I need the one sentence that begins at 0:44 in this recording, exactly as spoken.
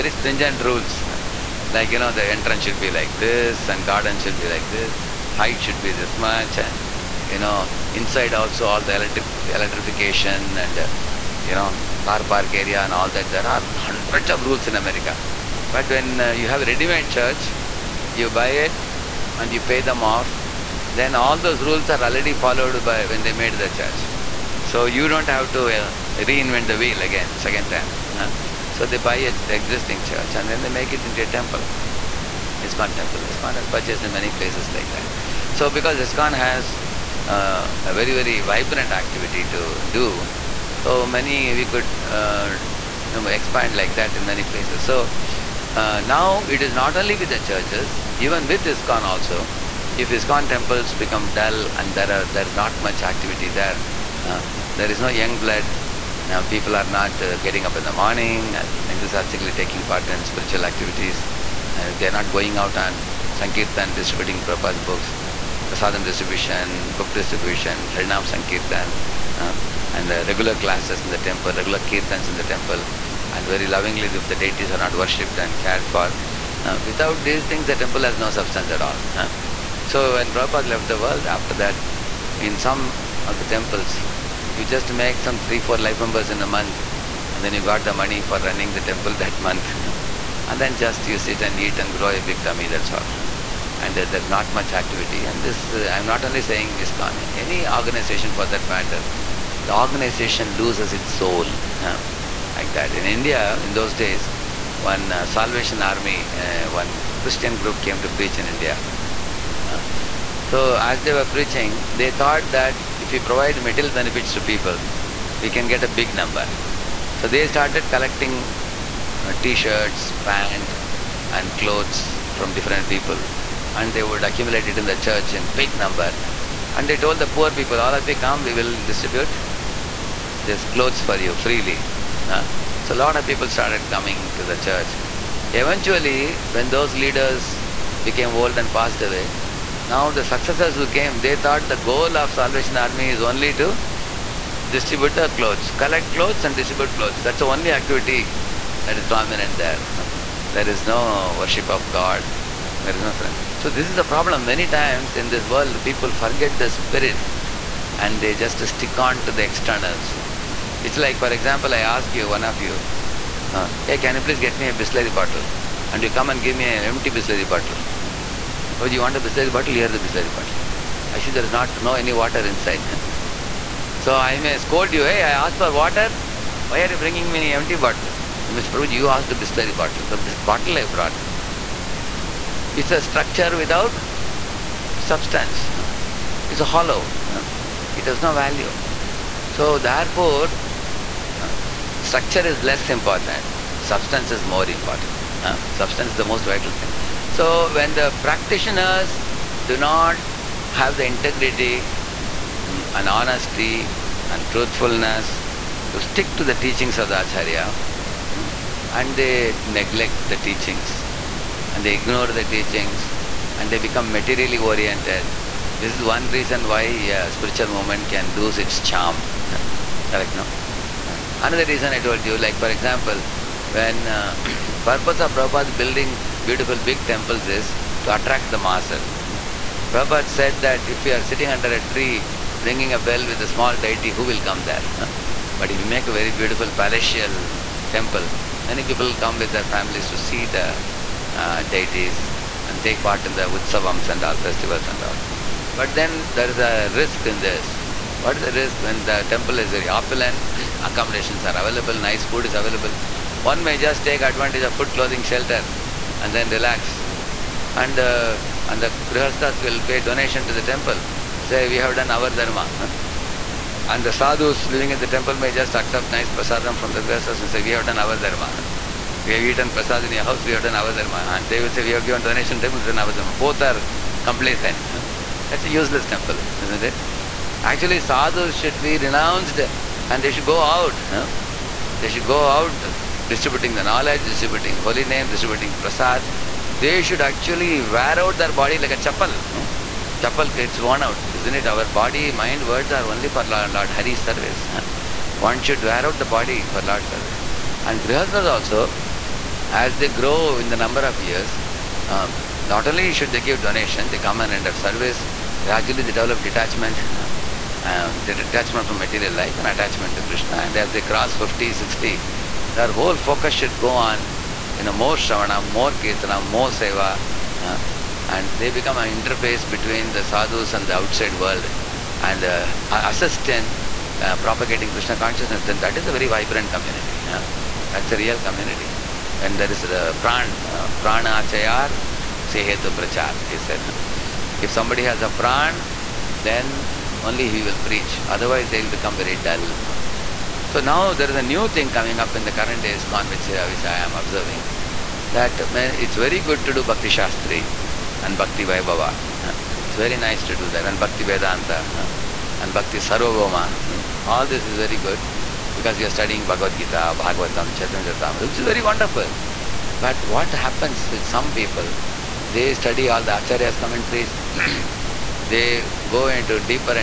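So uh, now it is not only with the churches, even with ISKCON also.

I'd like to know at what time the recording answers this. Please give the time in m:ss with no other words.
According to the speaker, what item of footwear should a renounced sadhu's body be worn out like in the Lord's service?
4:48.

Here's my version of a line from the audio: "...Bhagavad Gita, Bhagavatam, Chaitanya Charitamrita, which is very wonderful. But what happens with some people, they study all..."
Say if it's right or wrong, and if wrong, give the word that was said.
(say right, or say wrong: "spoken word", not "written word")
right.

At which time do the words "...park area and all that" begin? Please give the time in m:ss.
0:12.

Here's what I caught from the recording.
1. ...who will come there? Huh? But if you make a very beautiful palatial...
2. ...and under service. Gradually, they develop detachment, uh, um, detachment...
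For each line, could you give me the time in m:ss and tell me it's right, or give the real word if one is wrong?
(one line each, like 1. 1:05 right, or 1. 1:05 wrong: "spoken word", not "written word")
1. 3:54 right
2. 5:04 wrong: "enter", not "under".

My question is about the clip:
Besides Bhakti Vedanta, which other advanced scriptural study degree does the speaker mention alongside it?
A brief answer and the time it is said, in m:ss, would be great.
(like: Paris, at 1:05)
Bhakti Sarvabhauma, at 5:52.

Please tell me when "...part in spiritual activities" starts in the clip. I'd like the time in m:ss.
0:59.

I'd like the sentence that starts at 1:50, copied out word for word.
so as they were preaching, they thought that if we provide material benefits to people, we can get a big number.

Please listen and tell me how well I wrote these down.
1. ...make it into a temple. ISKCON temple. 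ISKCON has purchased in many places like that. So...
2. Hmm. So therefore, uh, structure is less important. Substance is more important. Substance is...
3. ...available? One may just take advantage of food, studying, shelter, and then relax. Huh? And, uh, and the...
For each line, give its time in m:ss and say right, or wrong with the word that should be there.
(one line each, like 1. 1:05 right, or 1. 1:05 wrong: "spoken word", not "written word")
1. 0:30 right
2. 3:08 right
3. 4:12 wrong: "clothing", not "studying".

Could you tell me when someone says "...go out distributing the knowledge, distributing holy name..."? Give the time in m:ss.
4:42.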